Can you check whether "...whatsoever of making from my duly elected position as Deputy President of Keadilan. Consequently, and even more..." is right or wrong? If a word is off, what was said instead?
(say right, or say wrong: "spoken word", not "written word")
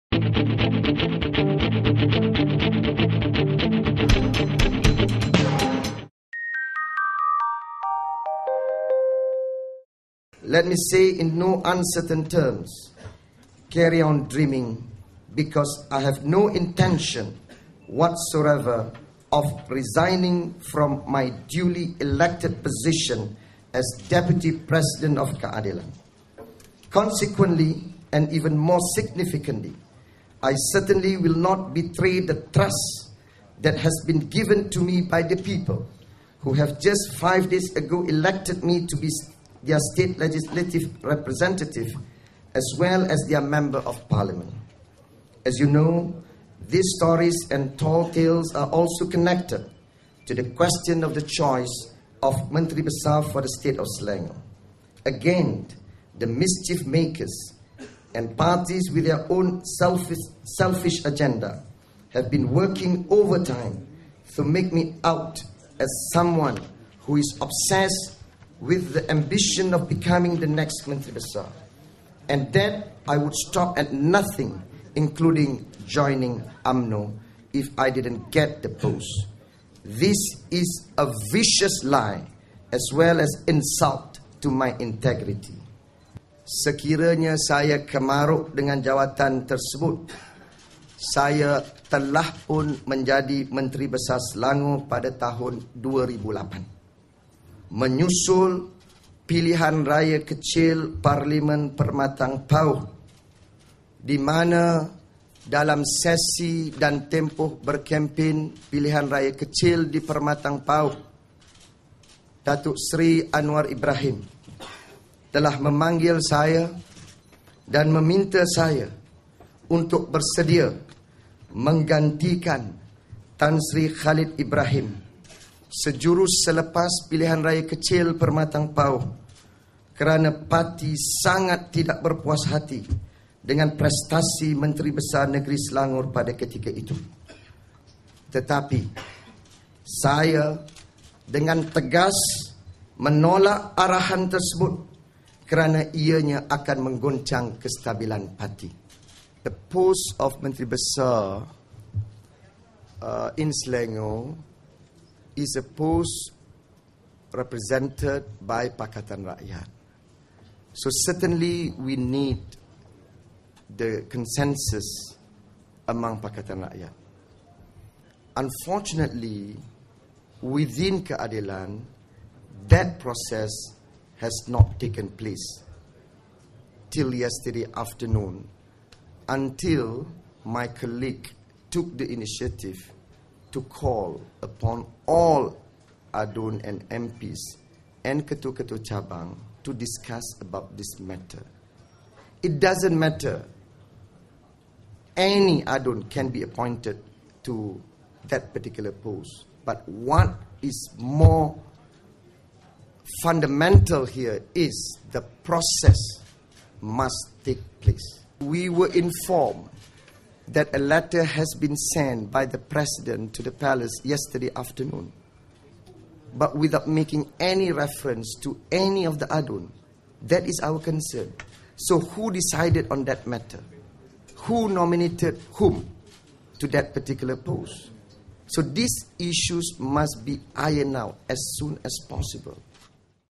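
wrong: "resigning", not "making".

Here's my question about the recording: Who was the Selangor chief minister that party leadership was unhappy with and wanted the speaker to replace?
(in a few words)
Tan Sri Khalid Ibrahim.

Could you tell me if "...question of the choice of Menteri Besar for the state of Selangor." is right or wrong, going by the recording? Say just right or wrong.
right.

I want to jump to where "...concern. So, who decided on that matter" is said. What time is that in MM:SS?
03:40.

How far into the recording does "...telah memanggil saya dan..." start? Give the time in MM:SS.
01:55.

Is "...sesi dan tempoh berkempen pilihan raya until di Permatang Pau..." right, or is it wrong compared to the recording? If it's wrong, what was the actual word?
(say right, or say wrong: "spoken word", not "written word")
wrong: "kecil", not "until".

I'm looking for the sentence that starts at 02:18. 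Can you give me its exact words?
Tetapi saya dengan tegas menolak arahan tersebut kerana ianya akan menggoncang kestabilan parti.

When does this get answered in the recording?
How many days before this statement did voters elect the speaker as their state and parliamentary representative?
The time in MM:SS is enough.
00:37.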